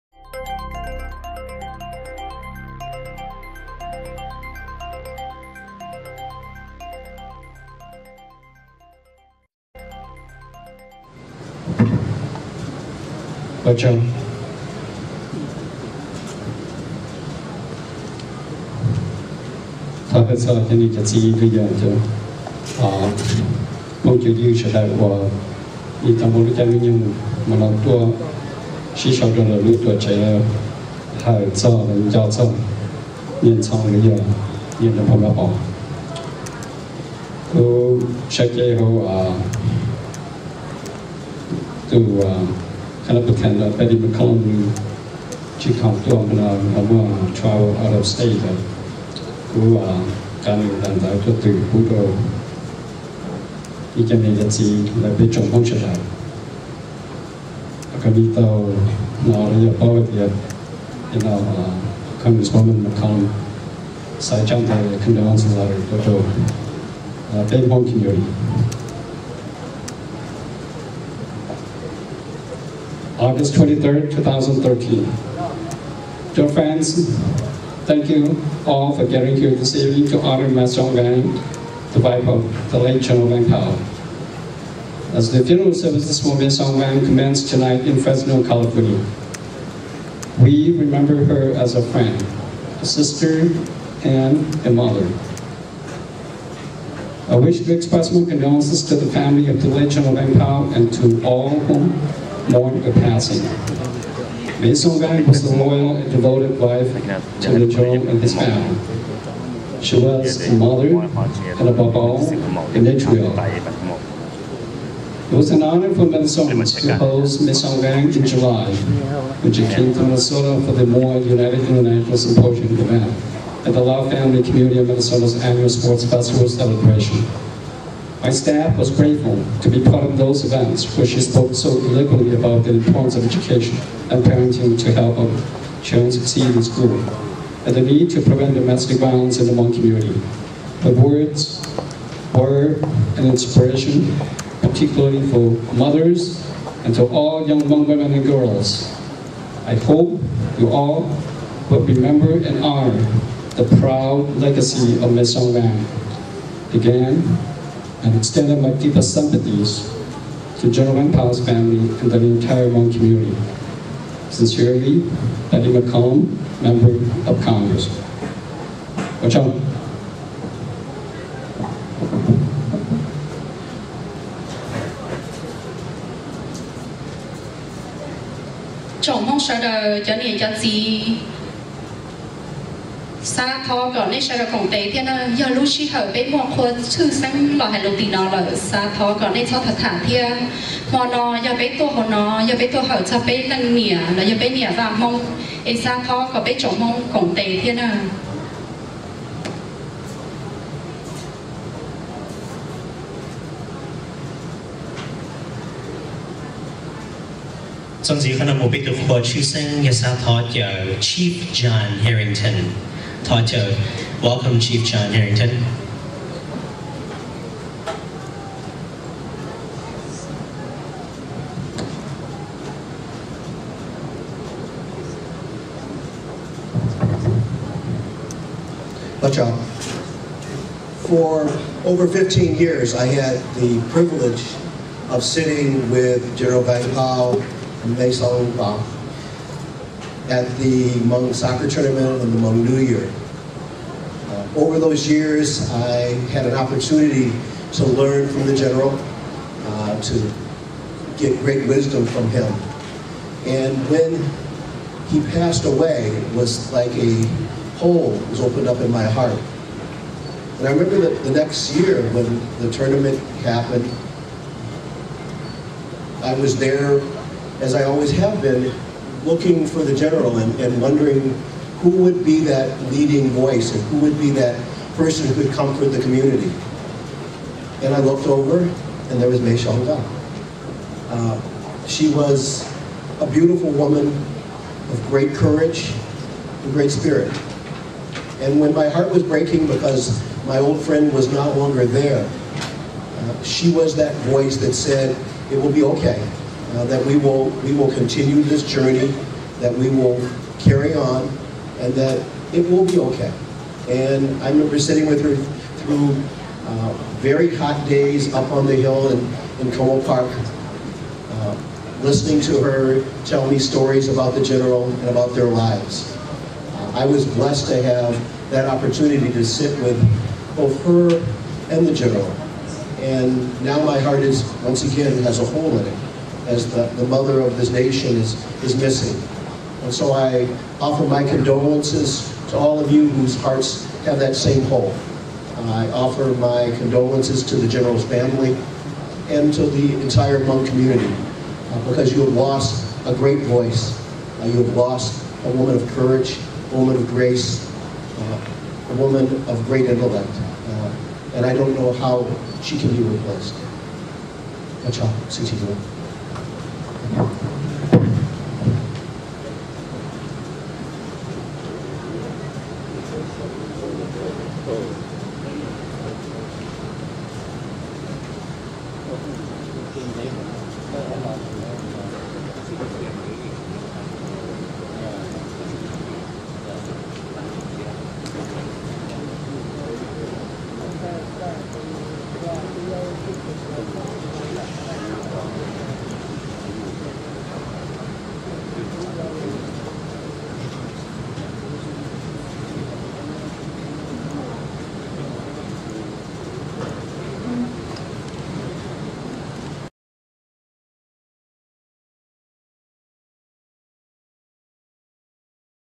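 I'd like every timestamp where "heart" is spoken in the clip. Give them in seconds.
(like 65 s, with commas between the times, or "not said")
259 s, 288 s, 323 s, 333 s.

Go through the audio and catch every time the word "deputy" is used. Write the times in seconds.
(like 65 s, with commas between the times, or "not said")
not said.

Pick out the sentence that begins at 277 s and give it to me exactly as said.
And I looked over and there was Mei Shonga.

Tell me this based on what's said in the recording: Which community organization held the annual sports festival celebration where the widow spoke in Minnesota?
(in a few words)
Lao Family Community of Minnesota.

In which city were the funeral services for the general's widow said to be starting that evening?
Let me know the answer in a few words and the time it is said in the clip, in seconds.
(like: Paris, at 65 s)
Fresno, California, at 88 s.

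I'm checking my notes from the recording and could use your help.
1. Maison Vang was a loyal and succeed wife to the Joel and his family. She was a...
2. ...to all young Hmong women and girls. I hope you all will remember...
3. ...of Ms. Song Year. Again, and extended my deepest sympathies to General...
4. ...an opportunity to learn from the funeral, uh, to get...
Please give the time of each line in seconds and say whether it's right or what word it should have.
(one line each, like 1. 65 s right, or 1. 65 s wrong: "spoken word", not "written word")
1. 104 s wrong: "devoted", not "succeed"
2. 146 s right
3. 155 s wrong: "Van", not "Year"
4. 246 s wrong: "general", not "funeral".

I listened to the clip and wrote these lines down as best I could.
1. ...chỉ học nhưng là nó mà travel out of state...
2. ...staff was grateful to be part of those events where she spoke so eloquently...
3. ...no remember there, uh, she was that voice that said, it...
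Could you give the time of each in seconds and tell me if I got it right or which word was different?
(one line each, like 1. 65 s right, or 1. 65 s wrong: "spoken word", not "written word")
1. 45 s wrong: "tuồng", not "nhưng"
2. 128 s right
3. 291 s wrong: "longer", not "remember".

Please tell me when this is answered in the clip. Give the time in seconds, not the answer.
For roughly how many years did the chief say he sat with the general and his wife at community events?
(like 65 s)
232 s.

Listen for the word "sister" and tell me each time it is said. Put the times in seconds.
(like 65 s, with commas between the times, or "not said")
92 s.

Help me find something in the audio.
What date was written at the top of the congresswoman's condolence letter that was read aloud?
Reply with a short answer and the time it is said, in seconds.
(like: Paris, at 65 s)
August 23rd, at 73 s.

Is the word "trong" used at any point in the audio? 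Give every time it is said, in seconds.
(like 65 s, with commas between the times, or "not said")
13 s, 55 s, 64 s.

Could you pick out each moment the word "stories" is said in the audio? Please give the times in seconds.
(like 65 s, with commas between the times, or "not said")
313 s.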